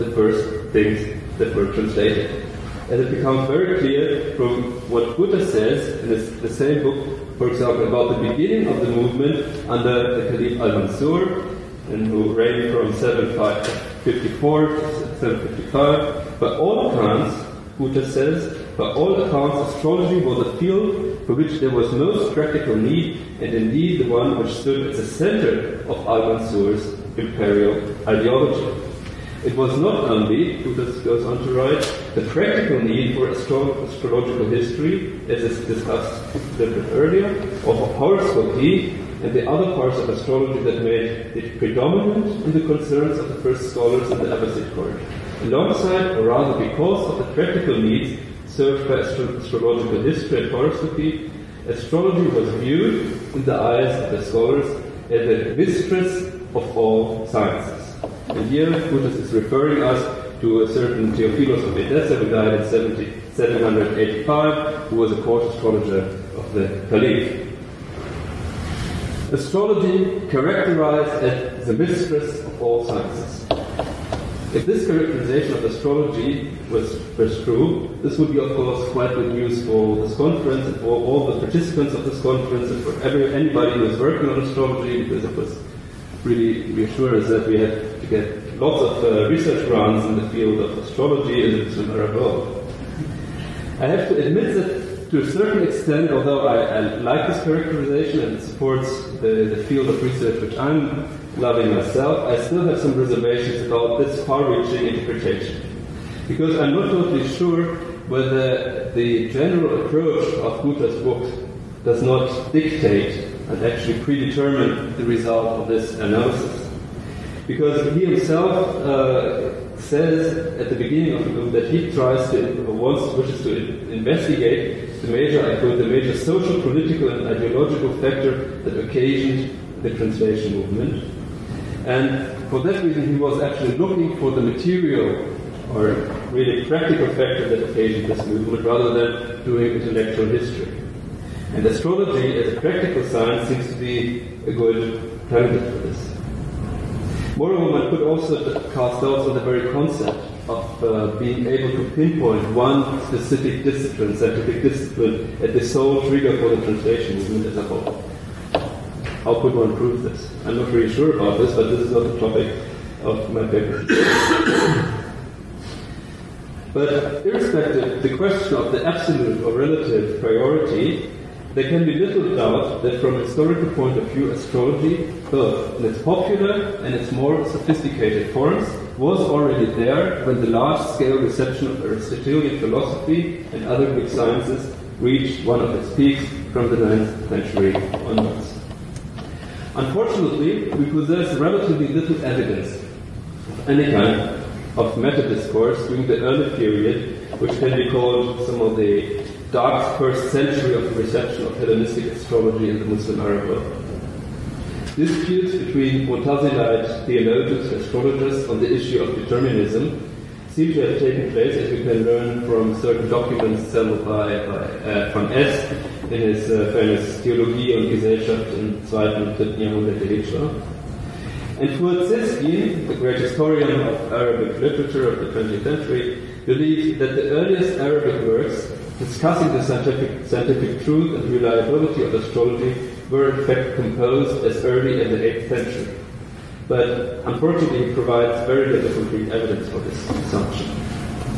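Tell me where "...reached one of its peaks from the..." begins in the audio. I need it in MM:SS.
03:04.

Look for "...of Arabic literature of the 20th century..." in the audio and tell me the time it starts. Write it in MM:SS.
03:43.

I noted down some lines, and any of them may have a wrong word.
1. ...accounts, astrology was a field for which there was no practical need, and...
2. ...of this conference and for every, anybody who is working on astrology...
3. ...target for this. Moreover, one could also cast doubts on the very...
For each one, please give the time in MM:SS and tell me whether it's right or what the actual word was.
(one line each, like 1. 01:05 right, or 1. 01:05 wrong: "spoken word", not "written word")
1. 00:19 right
2. 01:21 right
3. 02:25 right.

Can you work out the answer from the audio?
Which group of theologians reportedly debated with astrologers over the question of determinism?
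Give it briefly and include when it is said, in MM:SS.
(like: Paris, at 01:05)
Mu'tazilite, at 03:26.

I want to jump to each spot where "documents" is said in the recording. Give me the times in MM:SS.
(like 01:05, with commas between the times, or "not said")
03:33.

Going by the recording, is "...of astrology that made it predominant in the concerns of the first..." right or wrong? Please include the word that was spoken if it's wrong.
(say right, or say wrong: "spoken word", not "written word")
right.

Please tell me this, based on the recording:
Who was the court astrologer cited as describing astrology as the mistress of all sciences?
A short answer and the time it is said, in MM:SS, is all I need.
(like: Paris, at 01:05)
Theophilus of Edessa, at 01:01.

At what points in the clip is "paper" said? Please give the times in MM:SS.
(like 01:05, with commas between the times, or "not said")
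02:43.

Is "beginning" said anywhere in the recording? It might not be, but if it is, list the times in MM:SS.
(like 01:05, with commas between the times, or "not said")
00:08, 02:00.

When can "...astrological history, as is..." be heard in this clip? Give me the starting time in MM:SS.
00:33.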